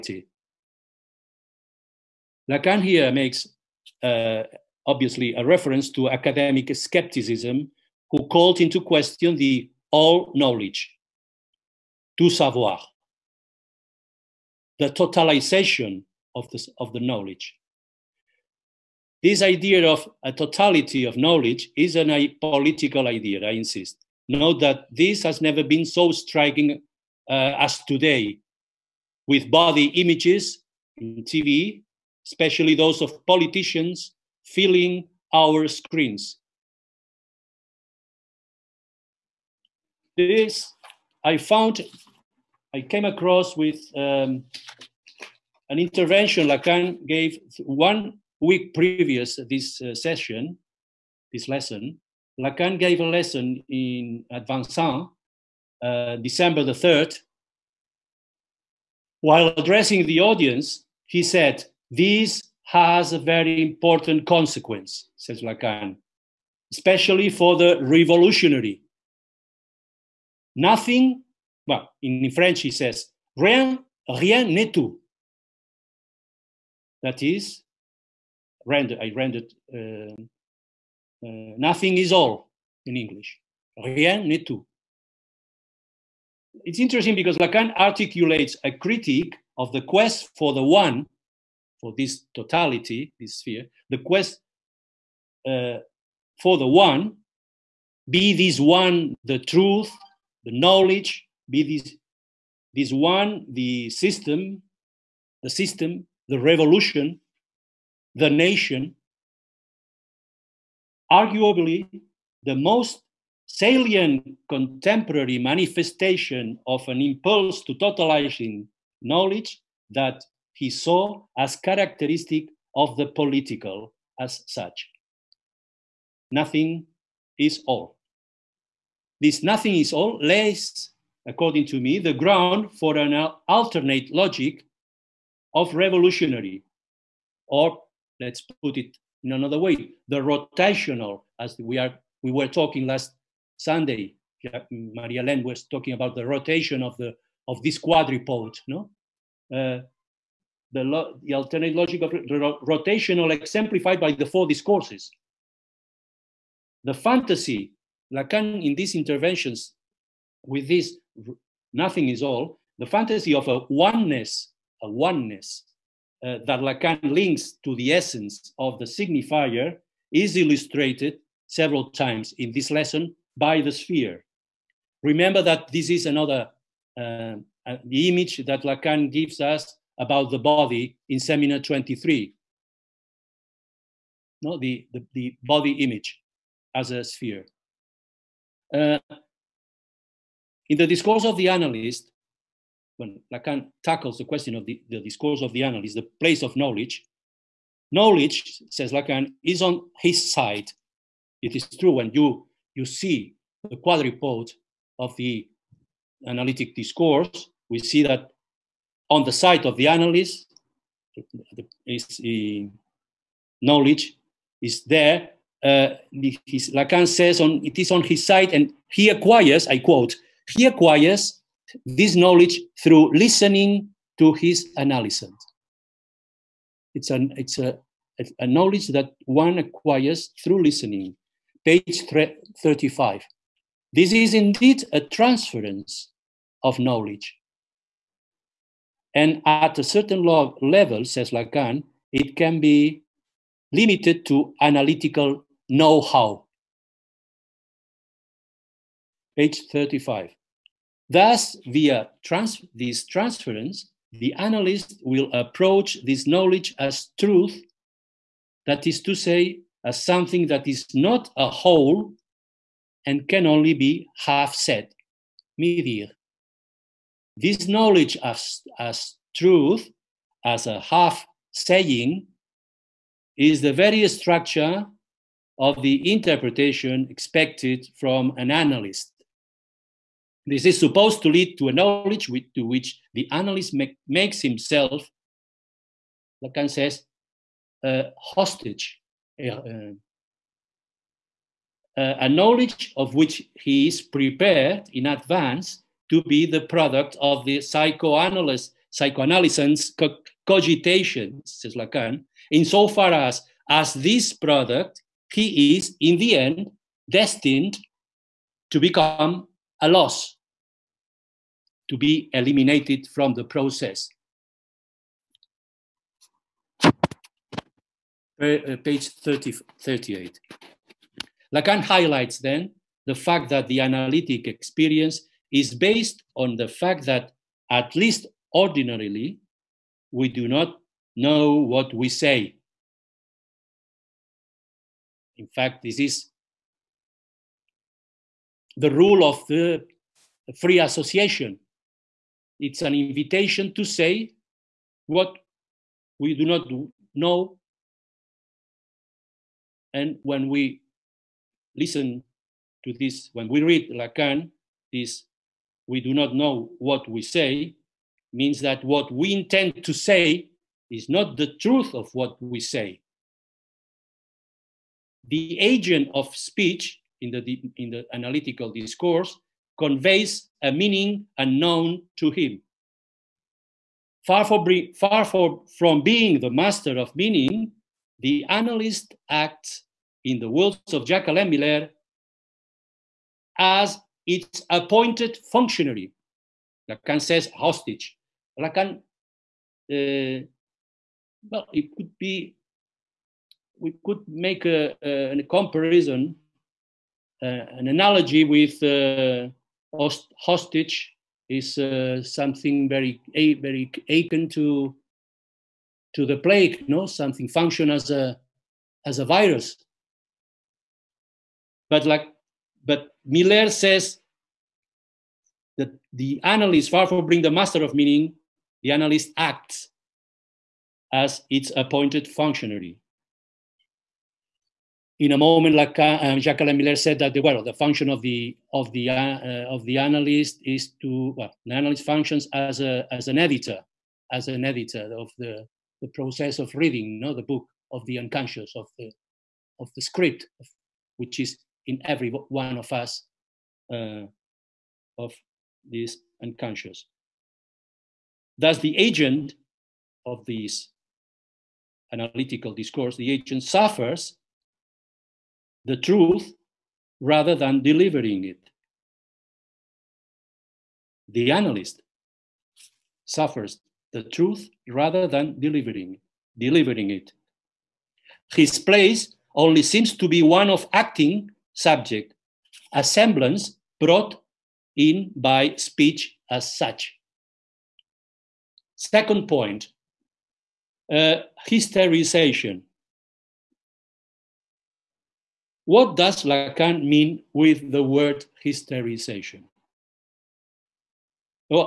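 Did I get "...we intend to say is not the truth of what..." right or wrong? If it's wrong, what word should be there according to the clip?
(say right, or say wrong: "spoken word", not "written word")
right.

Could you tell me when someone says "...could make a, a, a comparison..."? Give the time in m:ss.
6:34.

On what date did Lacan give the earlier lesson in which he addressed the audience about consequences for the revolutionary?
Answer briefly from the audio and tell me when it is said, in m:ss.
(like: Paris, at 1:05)
December 3rd, at 0:56.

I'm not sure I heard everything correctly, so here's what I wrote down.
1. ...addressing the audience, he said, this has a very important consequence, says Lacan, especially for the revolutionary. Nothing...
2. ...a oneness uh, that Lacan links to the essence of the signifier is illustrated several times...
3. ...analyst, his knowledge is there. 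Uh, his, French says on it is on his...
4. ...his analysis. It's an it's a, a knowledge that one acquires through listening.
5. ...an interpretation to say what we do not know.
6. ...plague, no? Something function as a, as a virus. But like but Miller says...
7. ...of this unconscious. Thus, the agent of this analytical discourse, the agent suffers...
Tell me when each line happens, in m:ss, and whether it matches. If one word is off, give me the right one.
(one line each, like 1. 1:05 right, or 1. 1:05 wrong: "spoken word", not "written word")
1. 0:59 right
2. 2:44 right
3. 3:29 wrong: "Lacan", not "French"
4. 3:44 right
5. 5:42 wrong: "invitation", not "interpretation"
6. 6:46 right
7. 7:25 right.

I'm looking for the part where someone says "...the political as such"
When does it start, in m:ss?
2:02.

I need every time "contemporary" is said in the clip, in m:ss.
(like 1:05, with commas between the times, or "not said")
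1:54.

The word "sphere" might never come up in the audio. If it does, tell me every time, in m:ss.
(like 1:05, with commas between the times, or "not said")
1:33, 2:53, 3:07.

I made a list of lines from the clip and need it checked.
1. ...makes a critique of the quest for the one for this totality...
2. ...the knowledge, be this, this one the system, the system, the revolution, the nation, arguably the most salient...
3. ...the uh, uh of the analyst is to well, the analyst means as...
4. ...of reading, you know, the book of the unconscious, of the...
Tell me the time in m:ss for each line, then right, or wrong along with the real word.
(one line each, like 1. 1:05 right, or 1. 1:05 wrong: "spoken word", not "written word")
1. 1:27 wrong: "articulates", not "makes"
2. 1:40 right
3. 7:08 wrong: "functions", not "means"
4. 7:16 right.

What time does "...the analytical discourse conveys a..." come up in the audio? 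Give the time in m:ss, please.
6:07.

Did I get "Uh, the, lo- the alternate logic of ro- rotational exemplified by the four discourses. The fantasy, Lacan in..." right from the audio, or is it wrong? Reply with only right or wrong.
right.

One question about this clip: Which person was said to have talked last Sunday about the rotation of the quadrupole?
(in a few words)
Maria Len.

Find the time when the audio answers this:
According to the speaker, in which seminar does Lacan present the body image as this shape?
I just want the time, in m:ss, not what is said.
3:01.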